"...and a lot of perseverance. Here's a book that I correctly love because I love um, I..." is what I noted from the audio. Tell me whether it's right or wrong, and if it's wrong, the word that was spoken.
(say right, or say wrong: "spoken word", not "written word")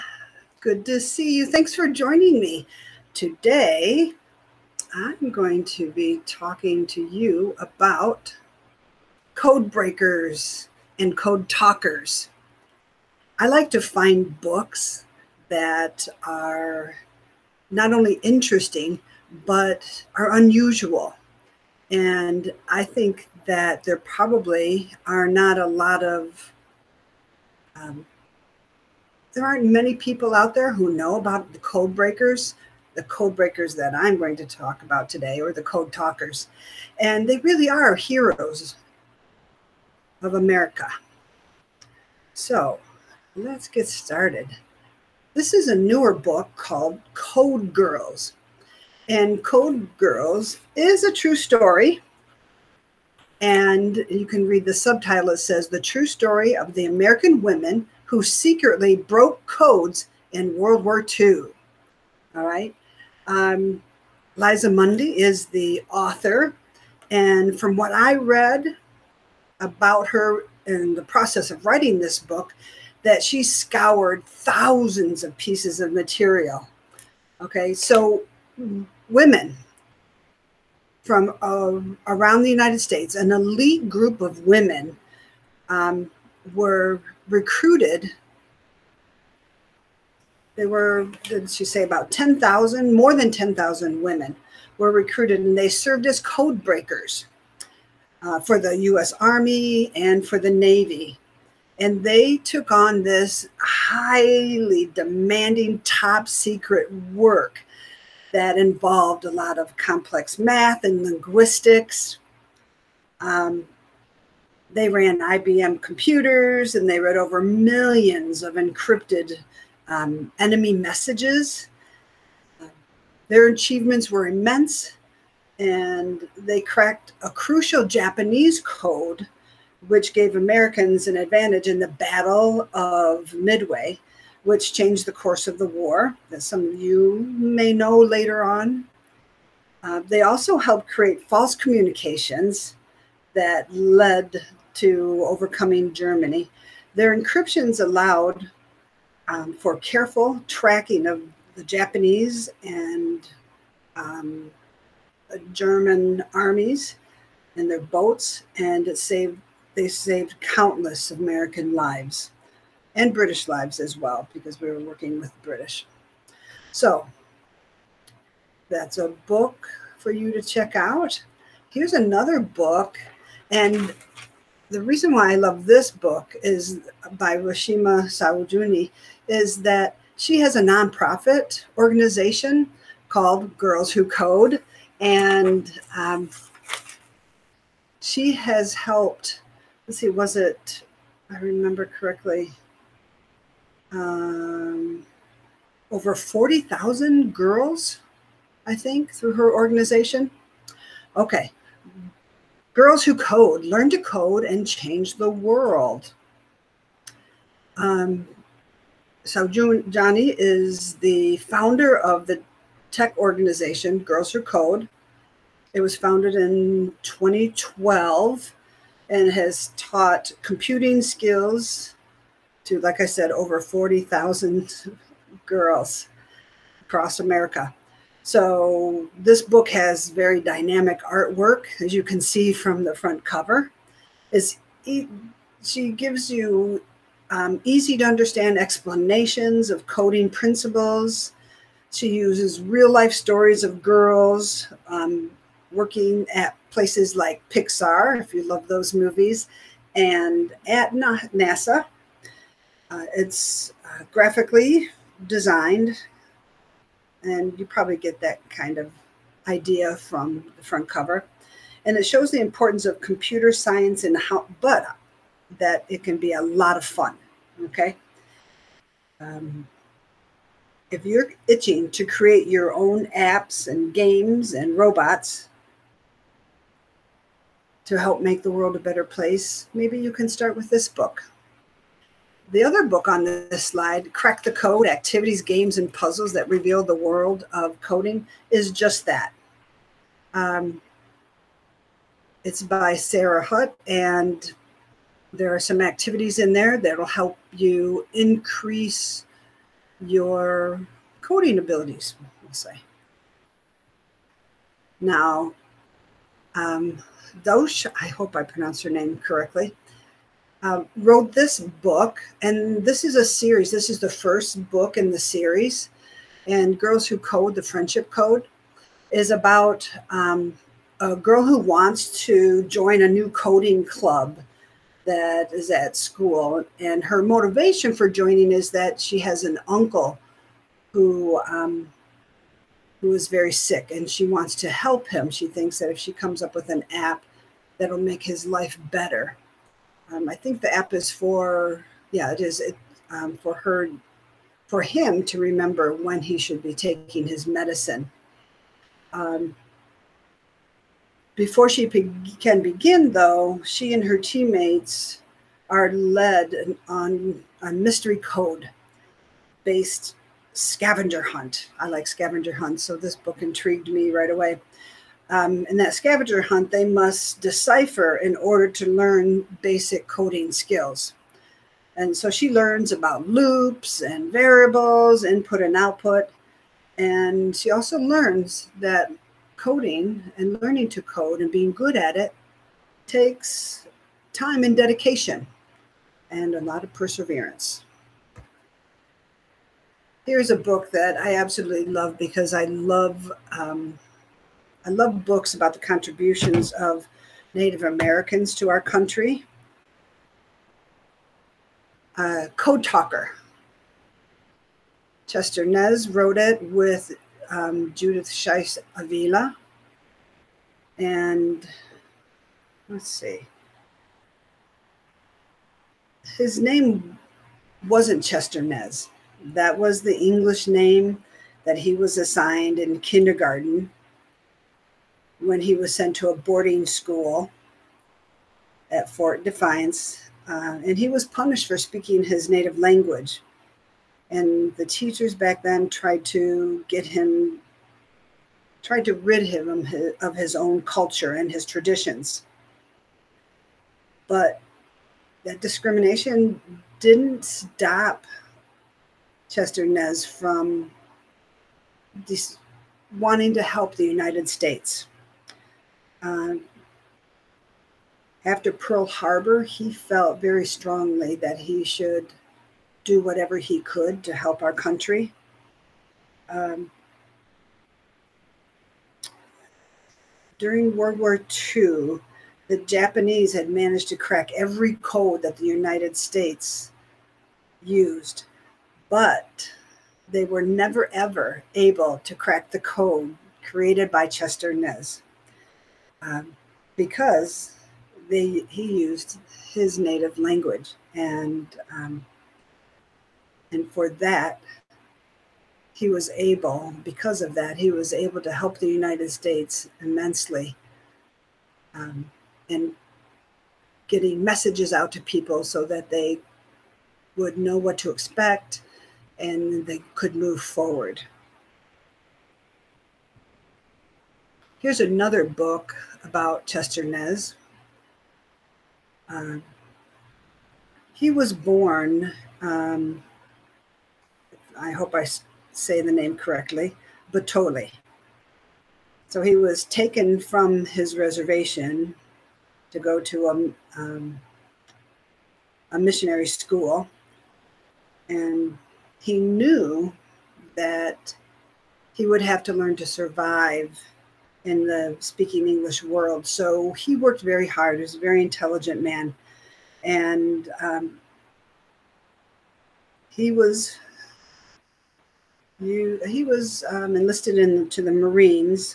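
wrong: "absolutely", not "correctly".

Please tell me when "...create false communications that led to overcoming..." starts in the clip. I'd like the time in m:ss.
2:20.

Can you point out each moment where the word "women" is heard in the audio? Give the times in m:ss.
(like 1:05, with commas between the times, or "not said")
0:57, 1:19, 1:24, 1:34.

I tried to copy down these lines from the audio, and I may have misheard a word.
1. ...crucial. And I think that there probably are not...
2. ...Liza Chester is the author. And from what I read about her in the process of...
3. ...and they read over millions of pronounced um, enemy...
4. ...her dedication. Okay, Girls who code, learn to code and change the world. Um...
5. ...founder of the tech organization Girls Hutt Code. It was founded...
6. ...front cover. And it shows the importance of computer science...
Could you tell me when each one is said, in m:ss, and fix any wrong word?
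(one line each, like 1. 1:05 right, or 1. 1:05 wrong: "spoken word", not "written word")
1. 0:20 wrong: "unusual", not "crucial"
2. 1:04 wrong: "Mundy", not "Chester"
3. 1:56 wrong: "encrypted", not "pronounced"
4. 3:19 wrong: "organization", not "dedication"
5. 3:31 wrong: "Who", not "Hutt"
6. 4:20 right.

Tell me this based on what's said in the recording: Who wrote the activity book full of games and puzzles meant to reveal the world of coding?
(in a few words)
Sarah Hutt.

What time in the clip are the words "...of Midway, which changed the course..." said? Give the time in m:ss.
2:12.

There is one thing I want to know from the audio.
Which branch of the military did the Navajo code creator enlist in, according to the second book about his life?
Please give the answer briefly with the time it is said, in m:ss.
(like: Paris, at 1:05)
Marines, at 9:18.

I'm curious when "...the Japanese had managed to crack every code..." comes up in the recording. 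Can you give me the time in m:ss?
7:52.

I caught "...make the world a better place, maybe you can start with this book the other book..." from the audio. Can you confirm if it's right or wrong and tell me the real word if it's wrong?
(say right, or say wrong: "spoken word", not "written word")
right.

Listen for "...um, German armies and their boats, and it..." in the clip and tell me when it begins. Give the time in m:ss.
2:33.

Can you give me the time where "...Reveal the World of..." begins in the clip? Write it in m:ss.
4:46.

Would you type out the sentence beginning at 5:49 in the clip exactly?
Um, before she can begin, though, she and her teammates are led on a mystery code based scavenger hunt.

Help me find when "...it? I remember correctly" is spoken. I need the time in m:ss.
3:10.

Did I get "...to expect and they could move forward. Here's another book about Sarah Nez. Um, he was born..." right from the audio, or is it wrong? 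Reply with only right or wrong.
wrong.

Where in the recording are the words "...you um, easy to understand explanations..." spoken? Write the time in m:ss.
3:56.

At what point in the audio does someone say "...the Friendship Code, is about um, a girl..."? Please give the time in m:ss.
5:17.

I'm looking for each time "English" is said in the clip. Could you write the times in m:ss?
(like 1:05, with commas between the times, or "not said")
7:00, 9:05.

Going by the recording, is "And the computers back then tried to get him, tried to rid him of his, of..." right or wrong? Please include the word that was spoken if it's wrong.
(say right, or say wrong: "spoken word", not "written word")
wrong: "teachers", not "computers".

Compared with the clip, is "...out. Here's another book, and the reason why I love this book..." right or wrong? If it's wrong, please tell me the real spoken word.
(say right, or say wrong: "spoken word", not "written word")
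right.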